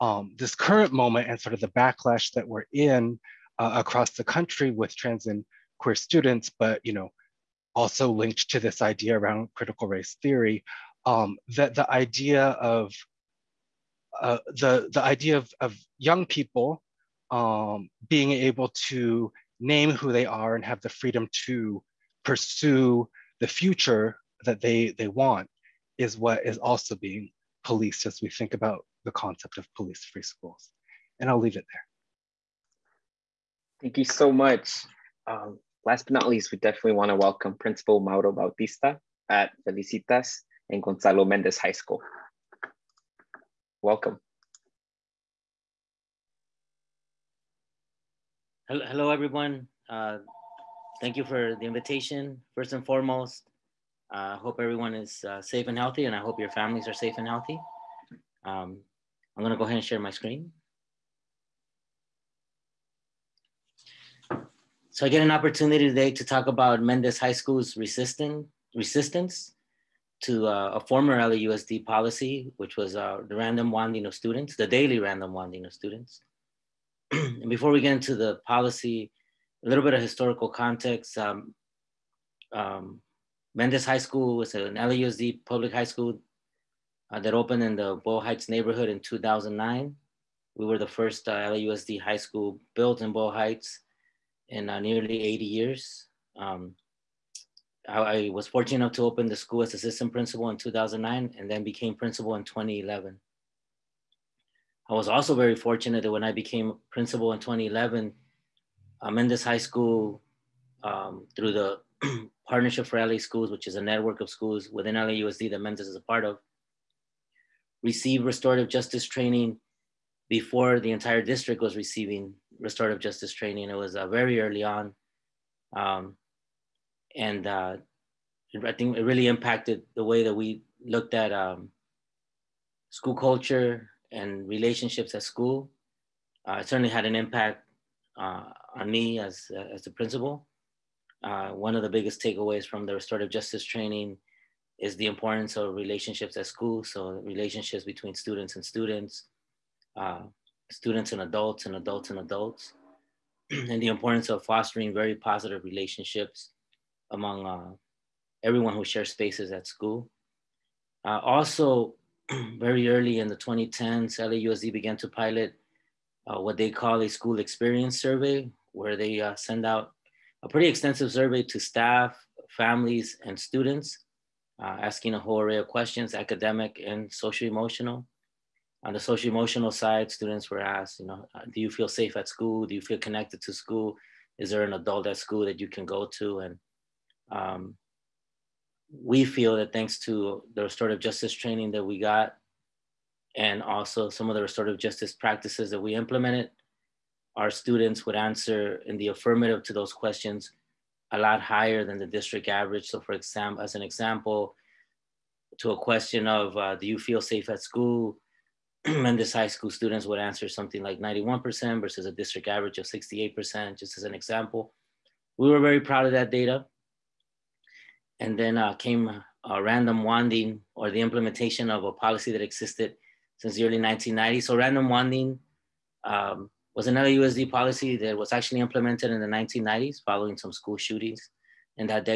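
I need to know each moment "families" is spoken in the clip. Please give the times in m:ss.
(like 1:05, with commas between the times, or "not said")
0:56, 2:52.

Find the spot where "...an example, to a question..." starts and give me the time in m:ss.
3:23.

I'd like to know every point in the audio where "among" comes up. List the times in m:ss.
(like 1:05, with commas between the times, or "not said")
2:37.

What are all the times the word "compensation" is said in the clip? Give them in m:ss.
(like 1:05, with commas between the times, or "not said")
not said.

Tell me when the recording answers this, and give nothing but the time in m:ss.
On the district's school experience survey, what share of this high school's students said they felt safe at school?
3:30.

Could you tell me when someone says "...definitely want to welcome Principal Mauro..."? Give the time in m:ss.
0:36.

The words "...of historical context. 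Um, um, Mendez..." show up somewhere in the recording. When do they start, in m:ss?
1:19.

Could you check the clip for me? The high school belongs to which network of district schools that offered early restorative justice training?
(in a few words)
Partnership for LA Schools.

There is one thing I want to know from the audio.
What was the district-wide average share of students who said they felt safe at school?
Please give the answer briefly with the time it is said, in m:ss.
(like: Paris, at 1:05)
68%, at 3:32.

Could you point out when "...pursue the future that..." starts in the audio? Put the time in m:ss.
0:22.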